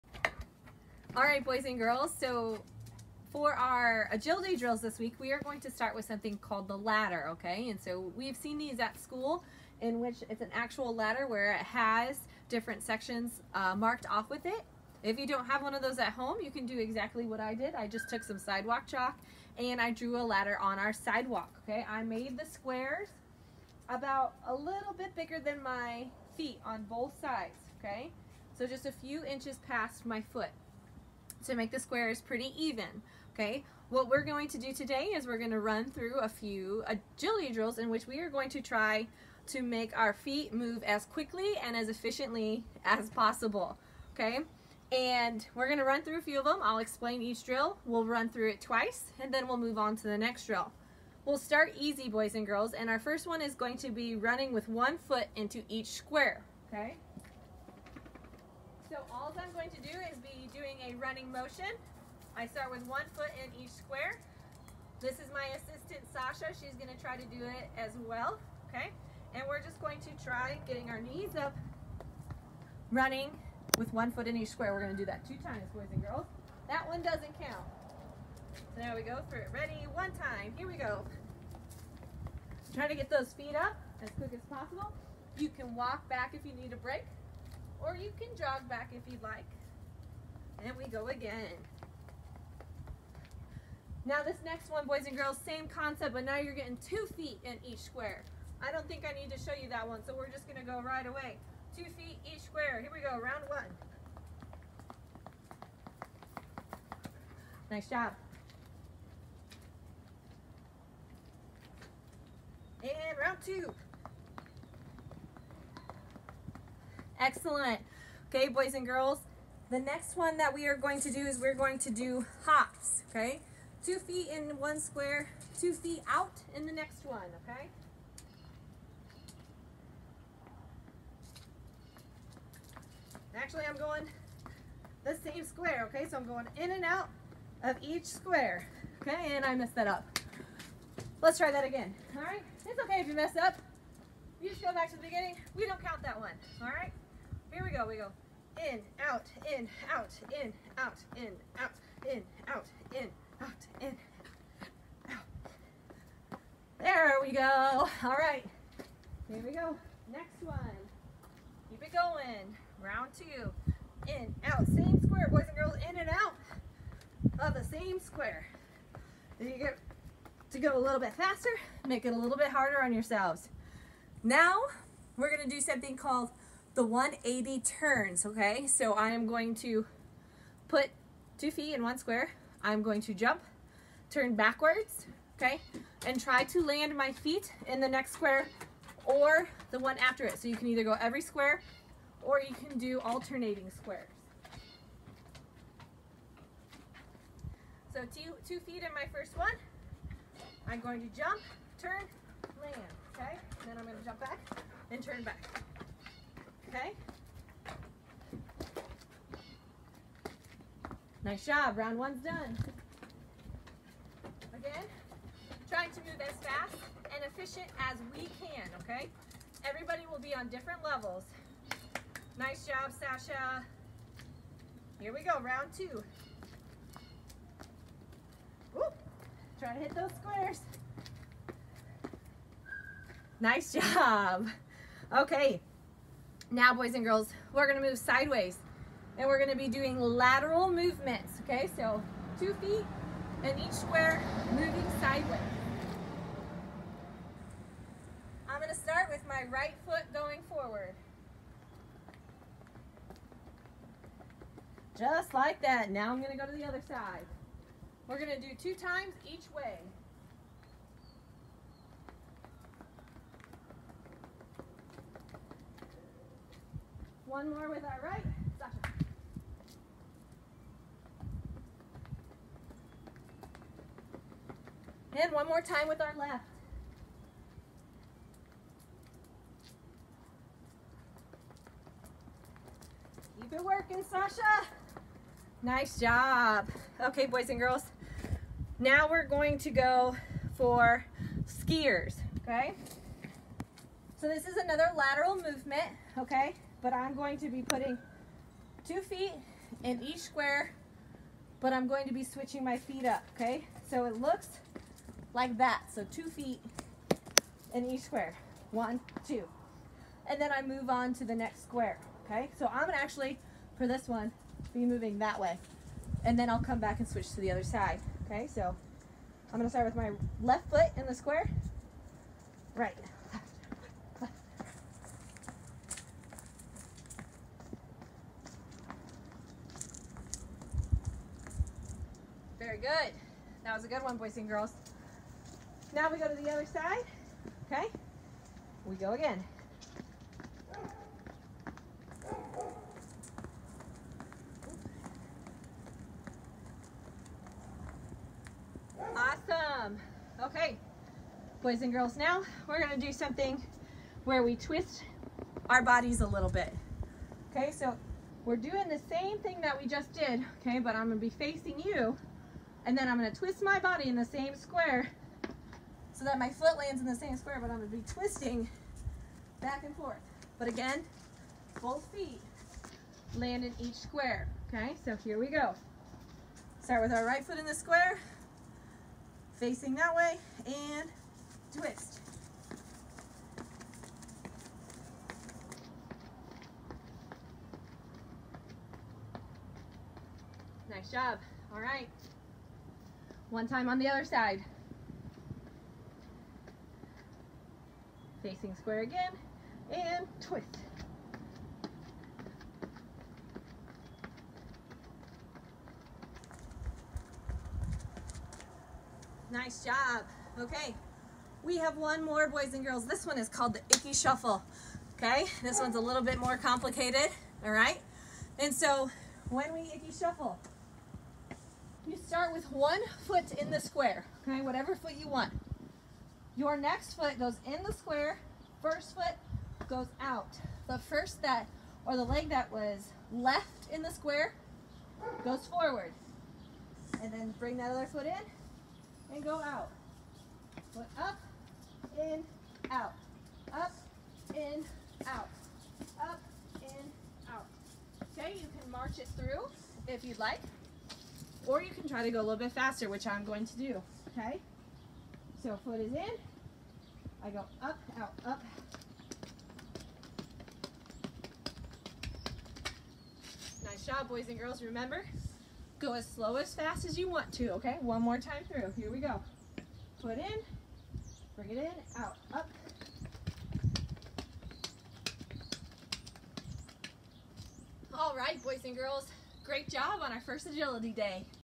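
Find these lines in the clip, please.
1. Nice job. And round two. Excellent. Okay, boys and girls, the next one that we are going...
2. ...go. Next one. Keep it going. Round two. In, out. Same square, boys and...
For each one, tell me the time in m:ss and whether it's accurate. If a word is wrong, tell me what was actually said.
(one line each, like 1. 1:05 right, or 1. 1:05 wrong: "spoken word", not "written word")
1. 1:47 right
2. 2:39 right.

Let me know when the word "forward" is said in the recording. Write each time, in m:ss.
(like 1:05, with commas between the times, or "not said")
4:10, 7:15.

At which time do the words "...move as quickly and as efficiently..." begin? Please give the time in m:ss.
0:40.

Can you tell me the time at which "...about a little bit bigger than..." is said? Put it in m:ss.
0:23.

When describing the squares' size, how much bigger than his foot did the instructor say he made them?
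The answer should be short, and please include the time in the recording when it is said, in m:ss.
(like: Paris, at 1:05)
a few inches, at 0:28.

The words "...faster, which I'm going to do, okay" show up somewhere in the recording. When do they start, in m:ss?
7:32.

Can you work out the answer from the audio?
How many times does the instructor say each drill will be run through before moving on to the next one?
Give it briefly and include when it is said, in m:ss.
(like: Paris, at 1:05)
twice, at 0:48.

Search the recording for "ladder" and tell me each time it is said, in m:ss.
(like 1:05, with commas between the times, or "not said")
0:06, 0:10, 0:20.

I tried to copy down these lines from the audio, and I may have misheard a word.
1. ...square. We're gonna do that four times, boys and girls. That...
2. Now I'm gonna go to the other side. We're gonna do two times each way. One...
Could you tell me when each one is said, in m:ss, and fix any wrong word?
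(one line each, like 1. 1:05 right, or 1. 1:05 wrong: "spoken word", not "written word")
1. 1:14 wrong: "two", not "four"
2. 4:15 right.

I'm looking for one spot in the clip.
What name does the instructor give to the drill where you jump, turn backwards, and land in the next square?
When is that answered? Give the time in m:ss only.
2:56.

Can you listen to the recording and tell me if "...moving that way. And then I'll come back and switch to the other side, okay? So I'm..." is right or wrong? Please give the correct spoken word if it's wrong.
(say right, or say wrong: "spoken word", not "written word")
right.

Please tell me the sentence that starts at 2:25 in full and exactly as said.
We don't count that one, all right?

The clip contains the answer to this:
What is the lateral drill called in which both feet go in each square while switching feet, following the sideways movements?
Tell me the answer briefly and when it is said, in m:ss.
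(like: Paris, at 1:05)
skiers, at 4:51.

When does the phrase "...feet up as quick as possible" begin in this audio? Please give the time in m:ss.
1:23.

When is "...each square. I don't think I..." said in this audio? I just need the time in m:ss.
1:37.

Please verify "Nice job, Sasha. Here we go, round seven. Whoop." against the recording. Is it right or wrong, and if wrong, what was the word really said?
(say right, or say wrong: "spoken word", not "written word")
wrong: "two", not "seven".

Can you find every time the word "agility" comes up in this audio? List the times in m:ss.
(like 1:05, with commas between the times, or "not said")
0:04, 0:36, 8:00.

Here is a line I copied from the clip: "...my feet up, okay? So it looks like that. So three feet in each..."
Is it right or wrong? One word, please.
wrong.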